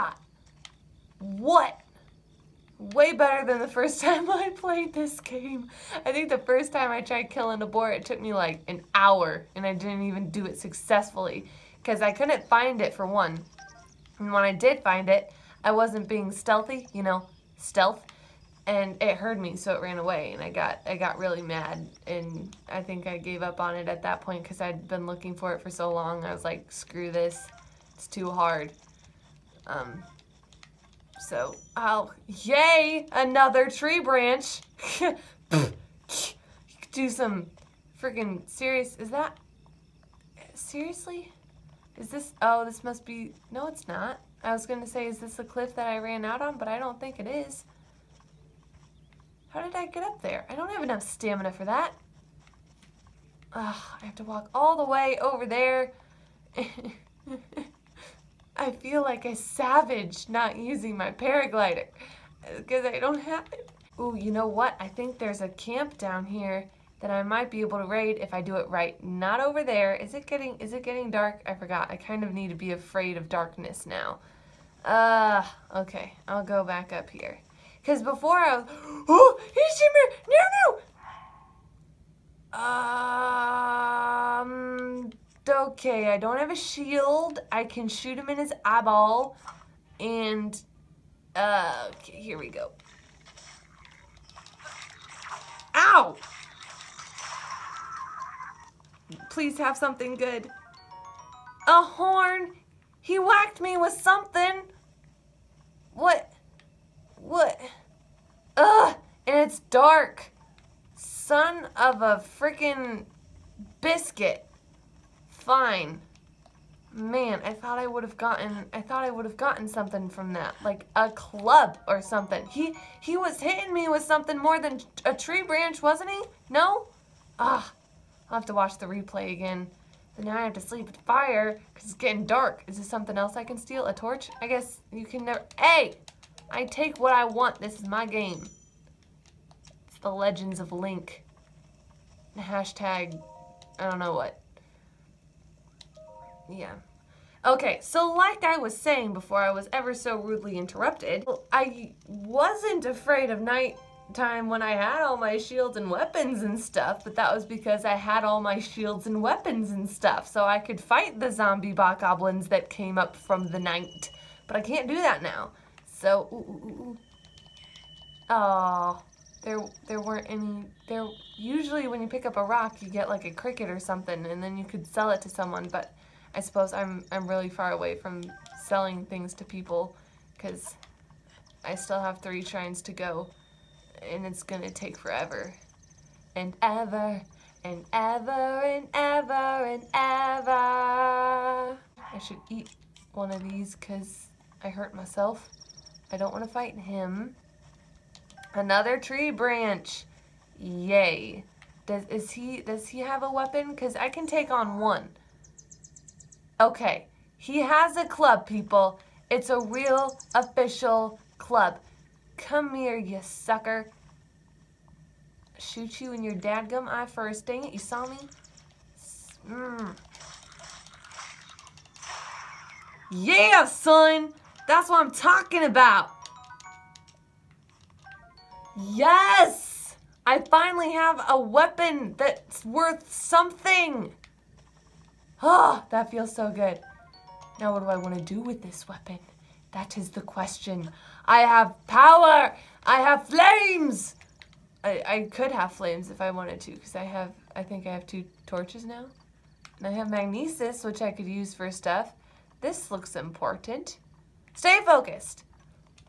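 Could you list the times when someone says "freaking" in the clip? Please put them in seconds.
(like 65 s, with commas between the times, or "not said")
37 s, 112 s.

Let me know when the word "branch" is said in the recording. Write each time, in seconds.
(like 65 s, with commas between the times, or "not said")
33 s, 125 s, 199 s.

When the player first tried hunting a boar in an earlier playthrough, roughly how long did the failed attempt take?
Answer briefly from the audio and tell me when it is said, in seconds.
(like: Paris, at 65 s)
an hour, at 8 s.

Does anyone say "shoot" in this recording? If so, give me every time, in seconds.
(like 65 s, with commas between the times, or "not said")
87 s, 215 s.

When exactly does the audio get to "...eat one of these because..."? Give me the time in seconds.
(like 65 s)
192 s.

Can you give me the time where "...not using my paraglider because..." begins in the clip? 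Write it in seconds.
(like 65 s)
60 s.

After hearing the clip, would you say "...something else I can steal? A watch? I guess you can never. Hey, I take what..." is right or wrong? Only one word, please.
wrong.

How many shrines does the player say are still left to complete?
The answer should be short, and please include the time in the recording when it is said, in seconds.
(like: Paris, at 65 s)
3, at 182 s.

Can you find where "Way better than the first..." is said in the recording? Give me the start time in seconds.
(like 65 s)
2 s.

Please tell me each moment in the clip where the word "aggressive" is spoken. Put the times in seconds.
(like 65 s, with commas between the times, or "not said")
not said.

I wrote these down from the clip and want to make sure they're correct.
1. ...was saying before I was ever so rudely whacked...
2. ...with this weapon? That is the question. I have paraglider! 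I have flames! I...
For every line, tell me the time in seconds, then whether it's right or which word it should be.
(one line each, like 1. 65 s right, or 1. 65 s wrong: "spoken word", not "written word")
1. 148 s wrong: "interrupted", not "whacked"
2. 238 s wrong: "power", not "paraglider".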